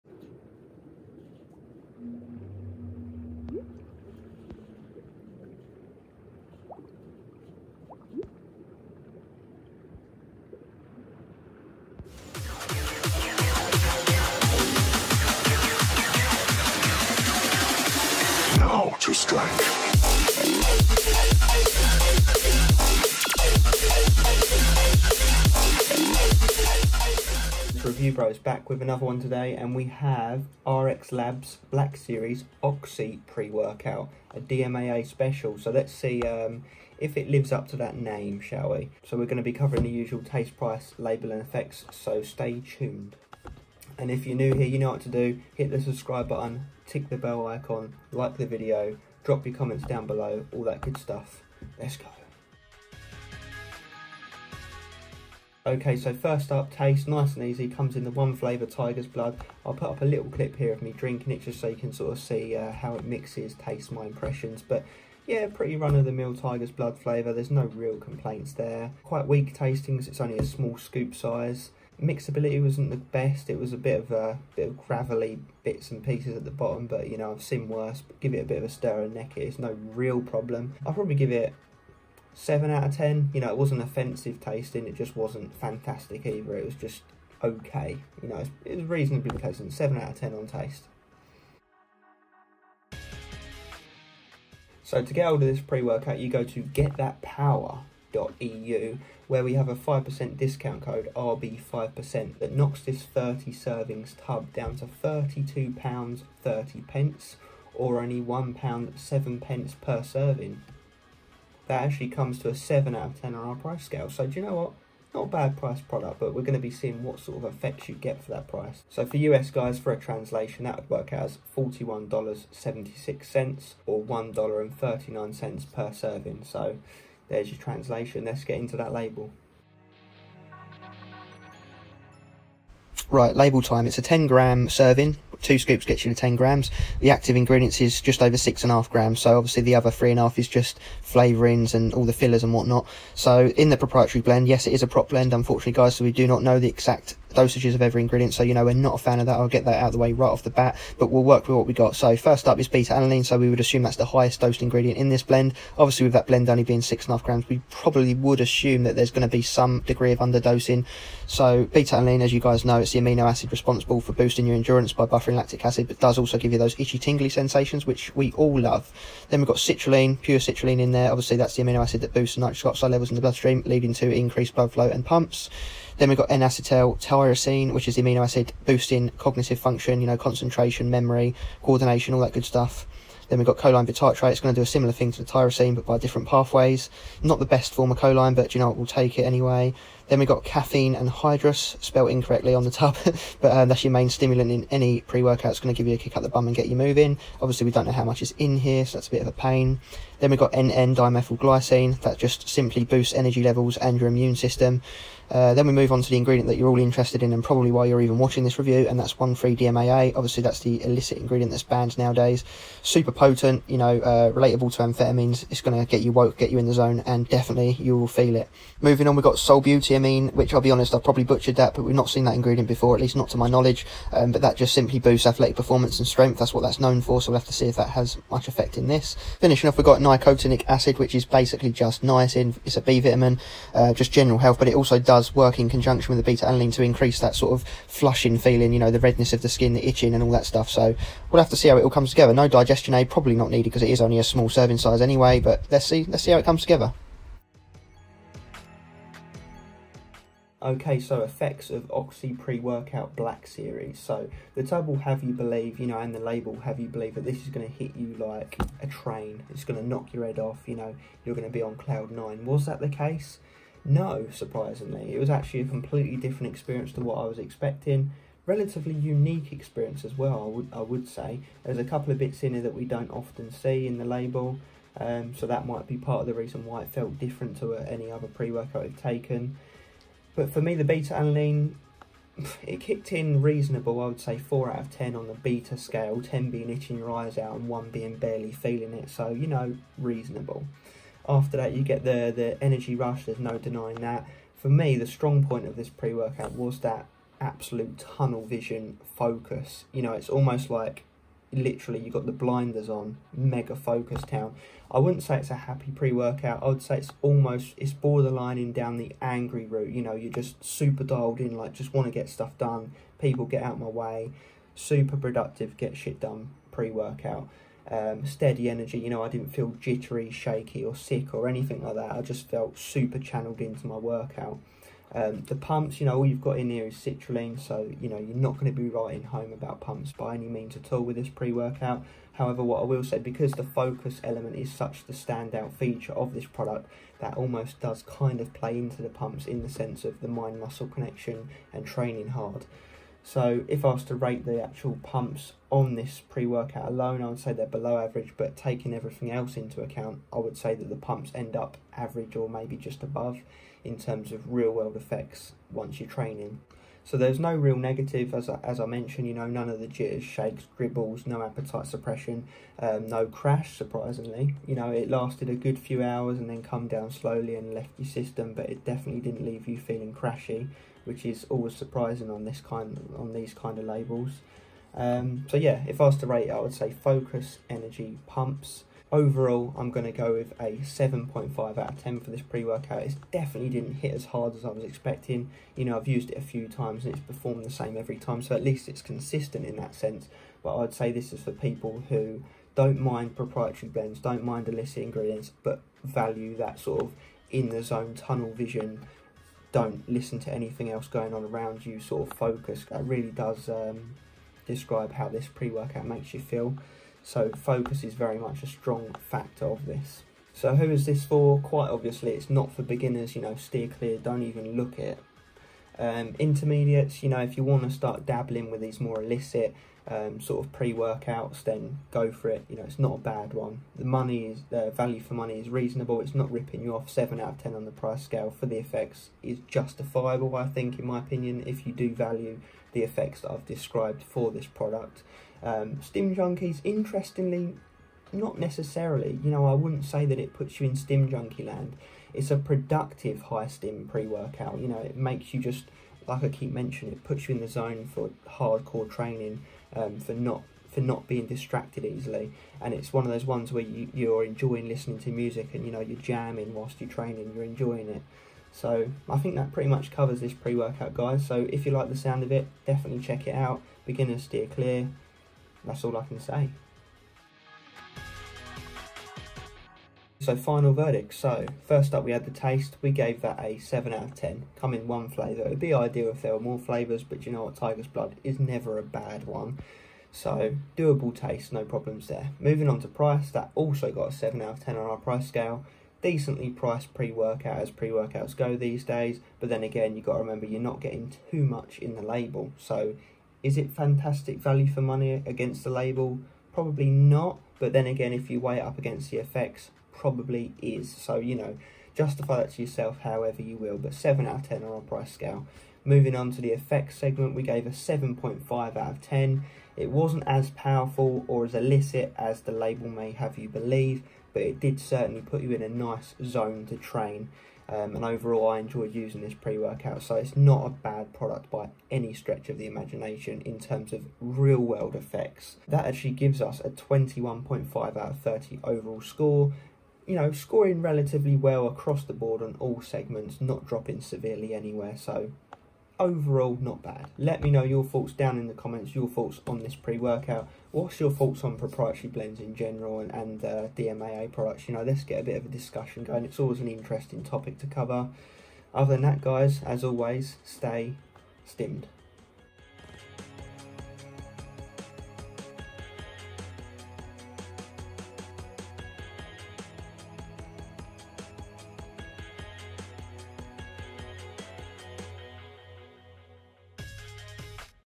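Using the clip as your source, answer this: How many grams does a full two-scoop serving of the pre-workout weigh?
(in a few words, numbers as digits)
10 grams.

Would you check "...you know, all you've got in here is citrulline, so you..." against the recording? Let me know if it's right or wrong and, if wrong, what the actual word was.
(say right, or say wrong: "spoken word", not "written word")
right.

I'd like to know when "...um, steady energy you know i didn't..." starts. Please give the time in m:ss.
5:17.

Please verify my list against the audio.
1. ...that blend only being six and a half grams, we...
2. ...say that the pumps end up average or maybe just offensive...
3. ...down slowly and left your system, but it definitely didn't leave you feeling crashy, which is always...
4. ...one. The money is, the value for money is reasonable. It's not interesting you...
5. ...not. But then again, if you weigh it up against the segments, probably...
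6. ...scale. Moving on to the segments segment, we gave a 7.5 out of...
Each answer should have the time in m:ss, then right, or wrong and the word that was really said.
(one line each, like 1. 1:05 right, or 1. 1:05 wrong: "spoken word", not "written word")
1. 2:36 right
2. 5:50 wrong: "above", not "offensive"
3. 6:06 right
4. 7:03 wrong: "ripping", not "interesting"
5. 8:17 wrong: "effects", not "segments"
6. 8:25 wrong: "effects", not "segments".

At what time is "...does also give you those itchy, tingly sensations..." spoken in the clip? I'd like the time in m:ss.
2:45.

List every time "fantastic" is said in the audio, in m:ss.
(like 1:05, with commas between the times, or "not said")
1:25, 8:13.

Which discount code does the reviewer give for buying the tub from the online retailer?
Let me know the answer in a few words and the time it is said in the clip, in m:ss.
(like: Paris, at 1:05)
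RB5%, at 1:41.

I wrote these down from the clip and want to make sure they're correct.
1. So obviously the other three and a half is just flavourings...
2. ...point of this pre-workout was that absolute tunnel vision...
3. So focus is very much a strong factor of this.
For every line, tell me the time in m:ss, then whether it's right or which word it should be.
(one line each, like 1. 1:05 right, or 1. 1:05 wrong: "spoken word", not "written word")
1. 2:19 right
2. 4:55 right
3. 6:47 right.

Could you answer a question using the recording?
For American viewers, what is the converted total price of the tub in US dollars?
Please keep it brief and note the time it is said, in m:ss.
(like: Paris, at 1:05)
$41.76, at 2:01.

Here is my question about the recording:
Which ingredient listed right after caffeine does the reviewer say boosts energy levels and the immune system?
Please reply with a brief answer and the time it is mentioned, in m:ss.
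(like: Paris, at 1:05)
NN dimethylglycine, at 3:20.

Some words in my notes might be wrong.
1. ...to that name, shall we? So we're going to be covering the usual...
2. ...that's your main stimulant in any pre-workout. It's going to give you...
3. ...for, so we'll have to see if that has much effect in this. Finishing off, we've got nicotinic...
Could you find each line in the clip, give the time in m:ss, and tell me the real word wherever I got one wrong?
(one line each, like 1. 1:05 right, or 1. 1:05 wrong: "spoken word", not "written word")
1. 0:37 right
2. 3:13 right
3. 3:47 right.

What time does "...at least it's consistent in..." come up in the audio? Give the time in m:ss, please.
6:28.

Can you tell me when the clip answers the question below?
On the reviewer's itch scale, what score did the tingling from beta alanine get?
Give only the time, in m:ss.
4:44.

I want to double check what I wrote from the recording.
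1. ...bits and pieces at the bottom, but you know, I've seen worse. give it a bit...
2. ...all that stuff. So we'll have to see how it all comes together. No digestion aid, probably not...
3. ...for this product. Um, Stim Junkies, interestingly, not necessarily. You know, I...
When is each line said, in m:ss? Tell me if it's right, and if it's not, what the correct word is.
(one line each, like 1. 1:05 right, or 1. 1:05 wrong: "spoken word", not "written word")
1. 1:15 right
2. 4:00 right
3. 7:14 right.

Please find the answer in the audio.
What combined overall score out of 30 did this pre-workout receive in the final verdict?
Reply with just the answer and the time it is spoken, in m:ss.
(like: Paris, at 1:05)
21.5, at 8:46.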